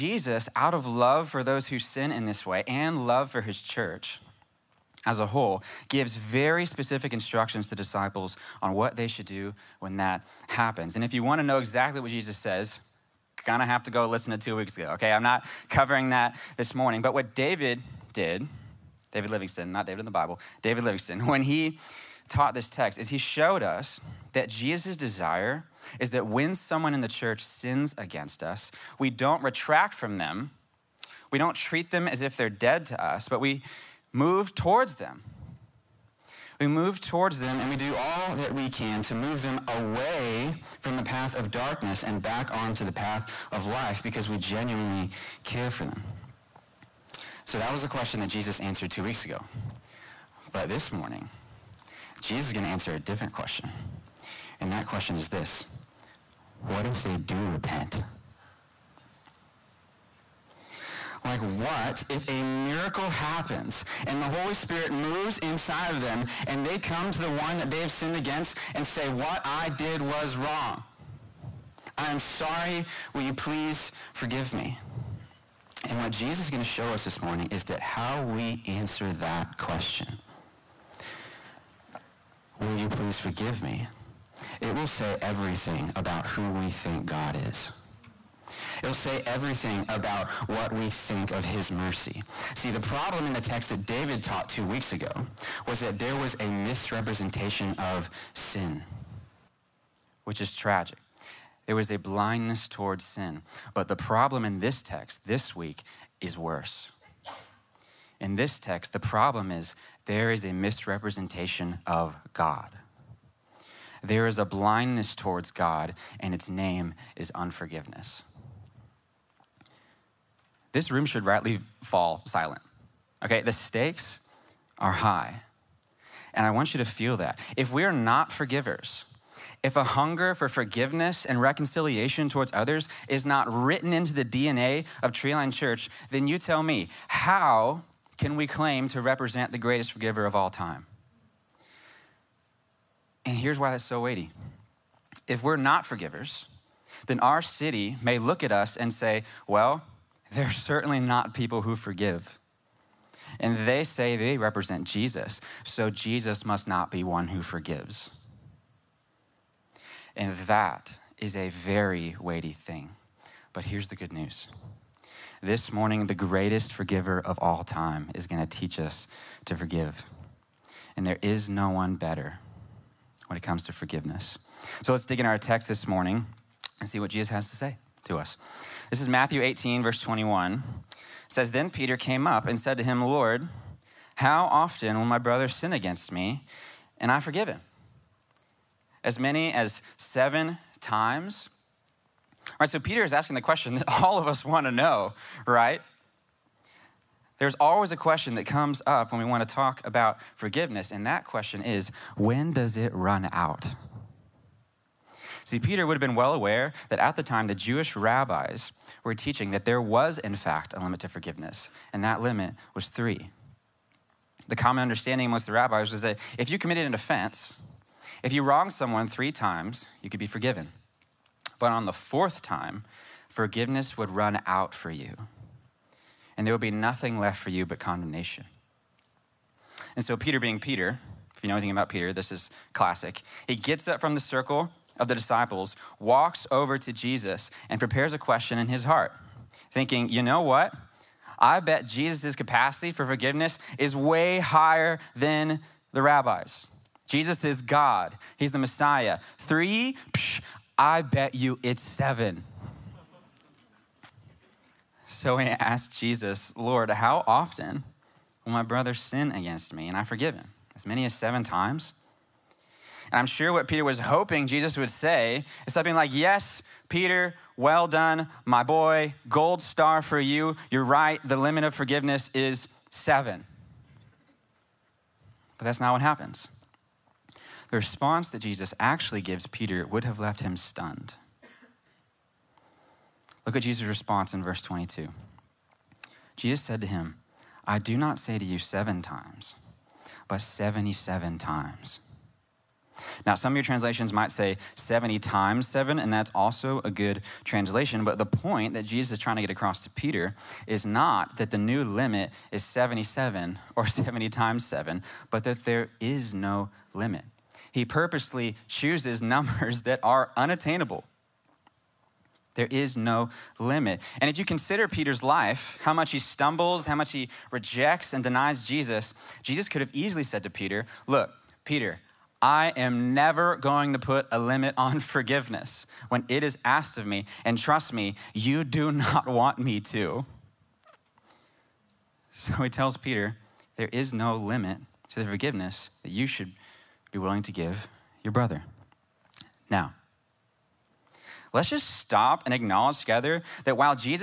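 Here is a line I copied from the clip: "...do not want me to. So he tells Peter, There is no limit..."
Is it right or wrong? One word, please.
right.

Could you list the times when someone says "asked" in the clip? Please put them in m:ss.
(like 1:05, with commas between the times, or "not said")
4:15, 5:26.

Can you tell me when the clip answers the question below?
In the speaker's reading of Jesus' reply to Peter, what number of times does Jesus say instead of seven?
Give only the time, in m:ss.
4:50.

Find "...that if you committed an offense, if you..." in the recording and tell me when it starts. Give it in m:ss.
3:36.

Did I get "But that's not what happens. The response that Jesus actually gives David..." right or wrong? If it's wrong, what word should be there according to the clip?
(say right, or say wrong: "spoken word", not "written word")
wrong: "Peter", not "David".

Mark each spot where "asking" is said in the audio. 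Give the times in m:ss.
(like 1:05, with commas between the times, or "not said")
3:13.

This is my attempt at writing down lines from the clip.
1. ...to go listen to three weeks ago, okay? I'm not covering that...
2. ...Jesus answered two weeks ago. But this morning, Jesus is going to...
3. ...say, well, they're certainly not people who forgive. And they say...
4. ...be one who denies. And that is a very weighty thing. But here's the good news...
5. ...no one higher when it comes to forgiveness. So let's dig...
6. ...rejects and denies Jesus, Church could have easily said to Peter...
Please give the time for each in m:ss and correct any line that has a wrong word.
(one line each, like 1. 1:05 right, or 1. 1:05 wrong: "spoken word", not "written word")
1. 0:13 wrong: "two", not "three"
2. 0:48 right
3. 2:28 right
4. 2:36 wrong: "forgives", not "denies"
5. 2:51 wrong: "better", not "higher"
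6. 5:17 wrong: "Jesus", not "Church".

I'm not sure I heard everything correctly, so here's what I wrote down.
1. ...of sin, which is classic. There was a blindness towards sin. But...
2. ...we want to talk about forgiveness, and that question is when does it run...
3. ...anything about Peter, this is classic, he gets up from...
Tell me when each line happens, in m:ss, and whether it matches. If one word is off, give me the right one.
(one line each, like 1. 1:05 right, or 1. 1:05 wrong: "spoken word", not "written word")
1. 1:37 wrong: "tragic", not "classic"
2. 3:19 right
3. 3:51 right.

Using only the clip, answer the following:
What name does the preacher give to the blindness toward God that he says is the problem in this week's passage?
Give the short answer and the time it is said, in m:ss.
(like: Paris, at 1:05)
Unforgiveness, at 1:57.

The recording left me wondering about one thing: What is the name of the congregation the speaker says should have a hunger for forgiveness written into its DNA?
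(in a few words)
Treeline Church.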